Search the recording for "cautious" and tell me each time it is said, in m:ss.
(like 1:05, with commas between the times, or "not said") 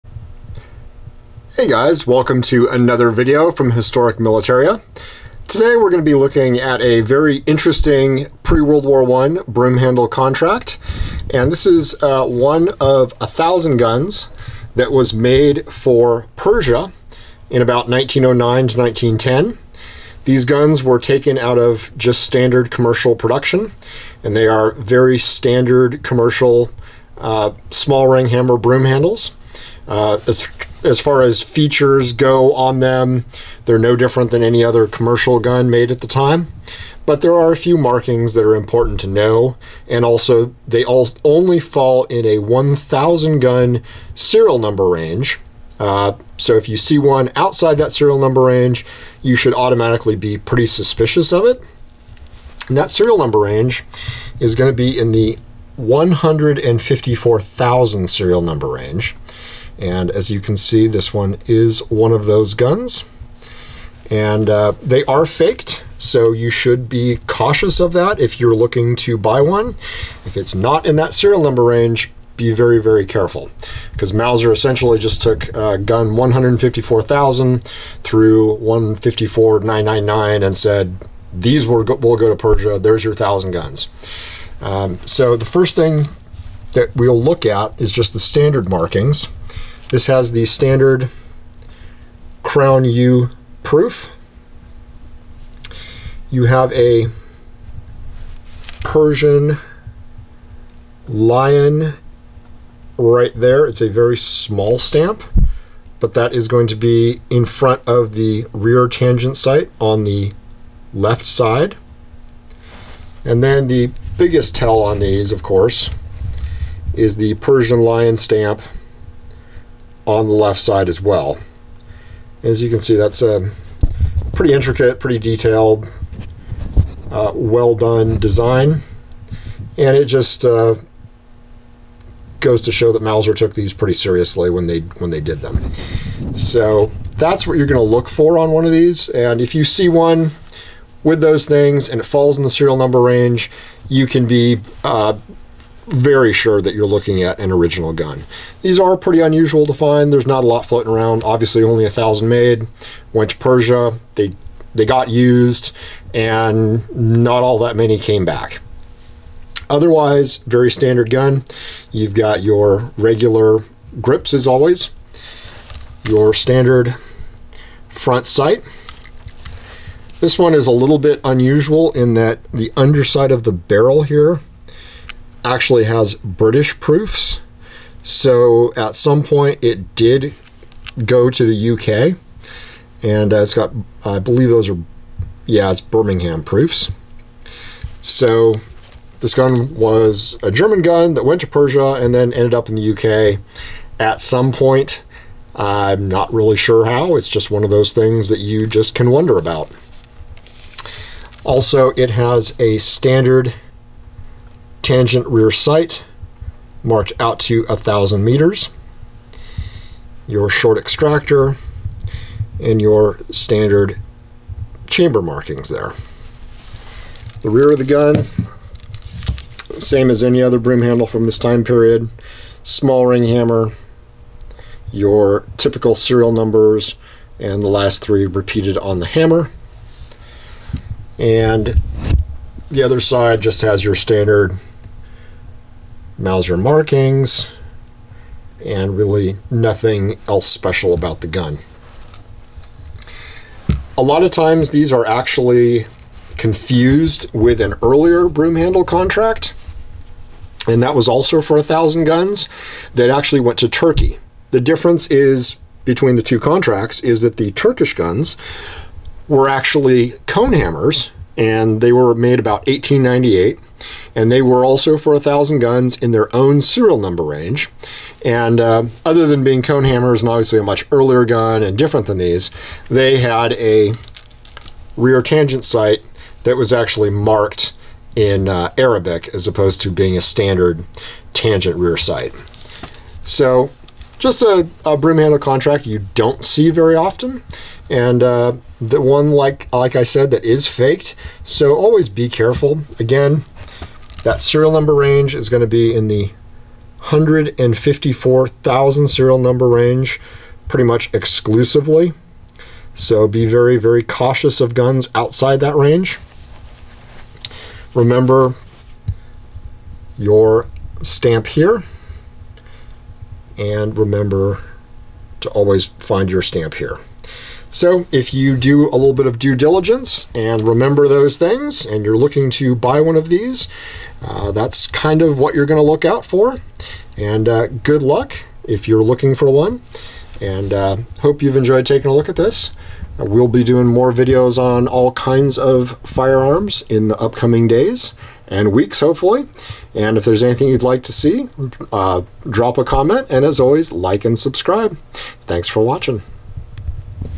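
1:07, 5:04.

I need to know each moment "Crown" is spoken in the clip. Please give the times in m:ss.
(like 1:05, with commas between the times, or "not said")
1:32.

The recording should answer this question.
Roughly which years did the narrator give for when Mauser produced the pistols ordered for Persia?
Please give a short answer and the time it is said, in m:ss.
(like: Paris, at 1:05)
1909 to 1910, at 0:17.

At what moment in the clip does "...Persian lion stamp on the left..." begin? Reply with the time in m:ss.
1:57.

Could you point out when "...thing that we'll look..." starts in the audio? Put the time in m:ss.
1:25.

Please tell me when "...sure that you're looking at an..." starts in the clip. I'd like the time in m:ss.
2:26.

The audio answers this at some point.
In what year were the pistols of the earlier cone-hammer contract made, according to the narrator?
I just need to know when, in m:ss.
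4:22.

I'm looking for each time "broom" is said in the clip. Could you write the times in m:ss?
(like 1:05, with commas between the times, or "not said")
0:28, 3:40, 4:08, 4:44.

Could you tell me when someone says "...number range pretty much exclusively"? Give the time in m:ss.
4:59.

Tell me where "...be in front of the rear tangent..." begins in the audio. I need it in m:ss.
1:46.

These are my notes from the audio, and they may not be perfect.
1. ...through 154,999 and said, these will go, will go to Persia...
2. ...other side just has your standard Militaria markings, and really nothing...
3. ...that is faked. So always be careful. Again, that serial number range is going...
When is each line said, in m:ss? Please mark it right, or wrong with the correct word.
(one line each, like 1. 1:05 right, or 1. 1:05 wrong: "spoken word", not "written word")
1. 1:18 right
2. 3:52 wrong: "Mauser", not "Militaria"
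3. 4:50 right.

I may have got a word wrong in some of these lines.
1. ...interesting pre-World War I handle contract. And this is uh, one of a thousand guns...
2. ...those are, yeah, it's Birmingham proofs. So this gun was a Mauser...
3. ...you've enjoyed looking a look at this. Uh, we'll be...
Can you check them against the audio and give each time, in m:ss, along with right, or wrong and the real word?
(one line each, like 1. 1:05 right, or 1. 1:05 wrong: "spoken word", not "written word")
1. 0:07 right
2. 3:04 wrong: "German", not "Mauser"
3. 5:31 wrong: "taking", not "looking".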